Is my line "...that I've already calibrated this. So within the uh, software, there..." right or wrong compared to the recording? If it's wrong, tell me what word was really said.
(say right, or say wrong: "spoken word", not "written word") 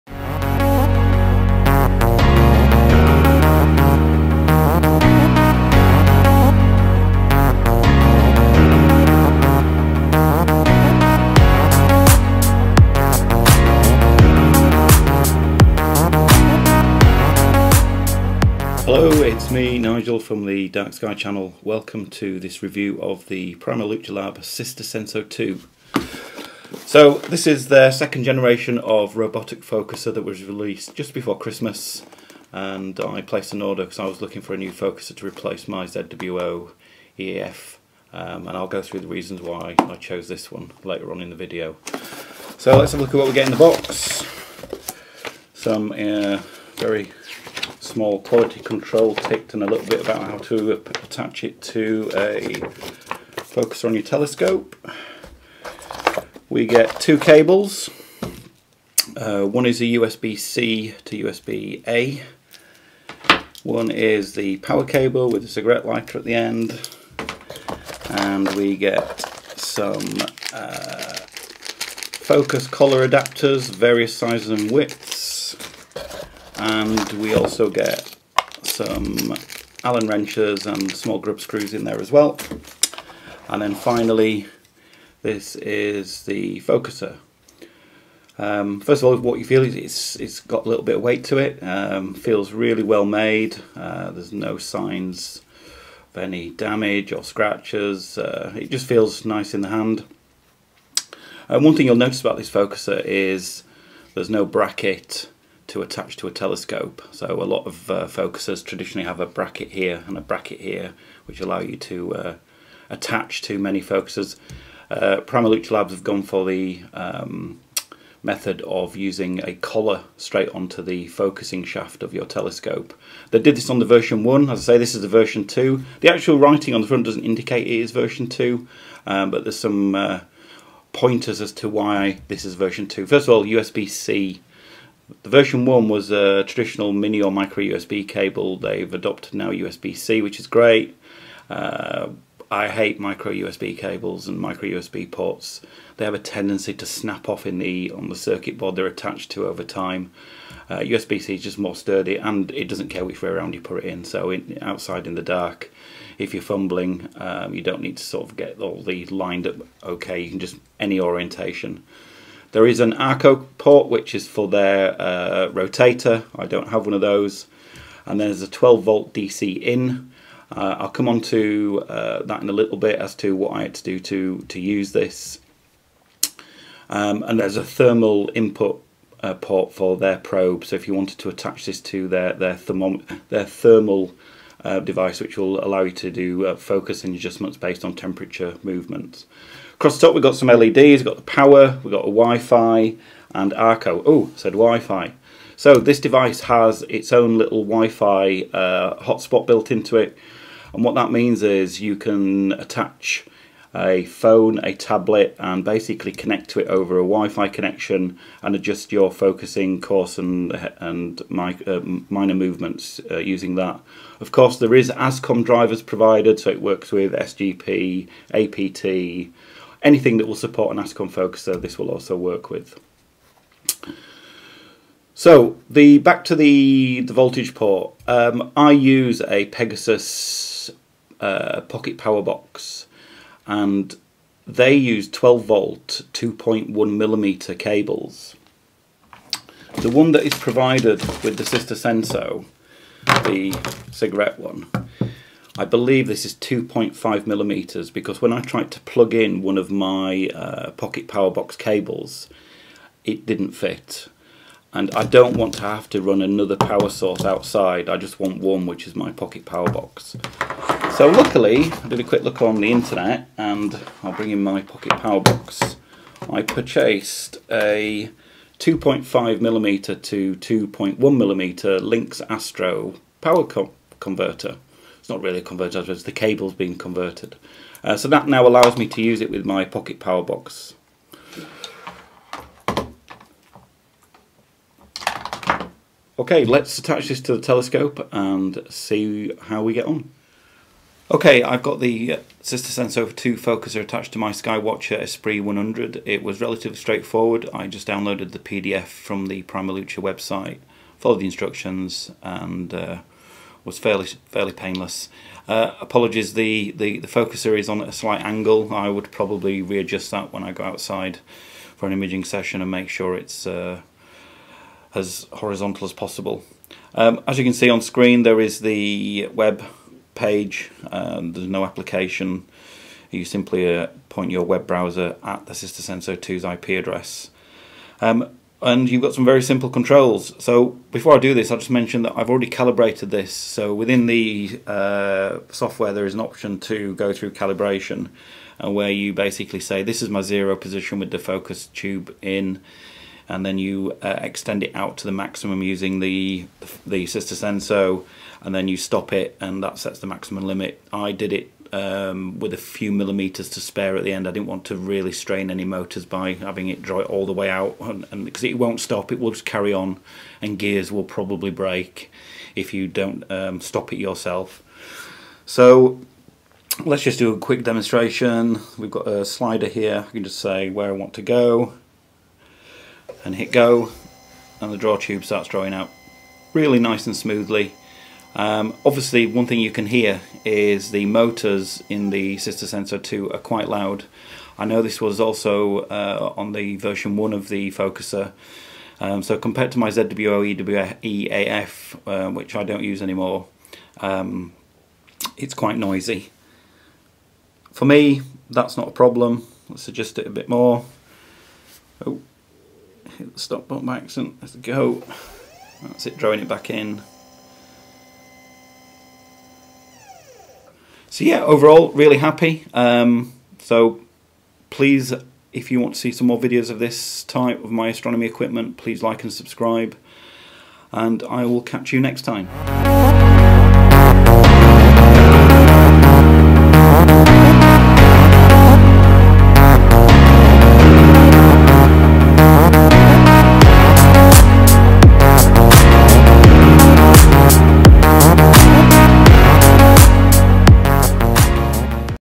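right.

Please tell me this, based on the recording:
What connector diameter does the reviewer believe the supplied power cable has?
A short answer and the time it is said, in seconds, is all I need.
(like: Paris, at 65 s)
2.5 millimeters, at 246 s.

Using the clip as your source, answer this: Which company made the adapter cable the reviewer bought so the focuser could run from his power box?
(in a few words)
Lynx Astro.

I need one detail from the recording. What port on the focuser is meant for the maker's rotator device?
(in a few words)
ARCO port.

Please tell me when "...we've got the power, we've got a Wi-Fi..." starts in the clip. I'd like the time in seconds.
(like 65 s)
190 s.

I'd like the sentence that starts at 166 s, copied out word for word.
I don't have one of those.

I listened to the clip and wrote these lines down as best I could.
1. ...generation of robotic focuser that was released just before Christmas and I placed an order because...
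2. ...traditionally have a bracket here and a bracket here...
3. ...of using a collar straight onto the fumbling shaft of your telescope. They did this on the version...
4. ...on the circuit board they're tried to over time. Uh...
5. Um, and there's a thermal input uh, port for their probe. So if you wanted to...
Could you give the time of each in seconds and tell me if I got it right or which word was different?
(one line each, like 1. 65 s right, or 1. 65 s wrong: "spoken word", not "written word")
1. 28 s right
2. 108 s right
3. 118 s wrong: "focusing", not "fumbling"
4. 147 s wrong: "attached", not "tried"
5. 176 s right.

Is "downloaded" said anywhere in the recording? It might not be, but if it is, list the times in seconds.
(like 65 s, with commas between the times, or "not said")
297 s.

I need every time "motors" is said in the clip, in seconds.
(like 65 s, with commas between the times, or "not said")
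355 s, 381 s.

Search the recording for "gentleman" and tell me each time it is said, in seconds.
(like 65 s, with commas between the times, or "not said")
not said.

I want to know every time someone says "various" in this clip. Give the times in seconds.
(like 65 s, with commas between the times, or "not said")
73 s.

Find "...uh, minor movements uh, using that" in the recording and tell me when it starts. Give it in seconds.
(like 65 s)
211 s.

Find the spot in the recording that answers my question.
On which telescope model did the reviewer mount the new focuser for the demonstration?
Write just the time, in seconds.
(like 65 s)
294 s.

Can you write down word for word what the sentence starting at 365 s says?
So let's just do a quick demonstration.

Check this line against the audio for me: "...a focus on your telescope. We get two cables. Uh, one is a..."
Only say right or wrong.
right.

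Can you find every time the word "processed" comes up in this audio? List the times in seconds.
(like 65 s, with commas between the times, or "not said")
not said.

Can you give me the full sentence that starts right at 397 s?
For me, that's not a problem.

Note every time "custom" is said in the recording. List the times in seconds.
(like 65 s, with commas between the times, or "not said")
not said.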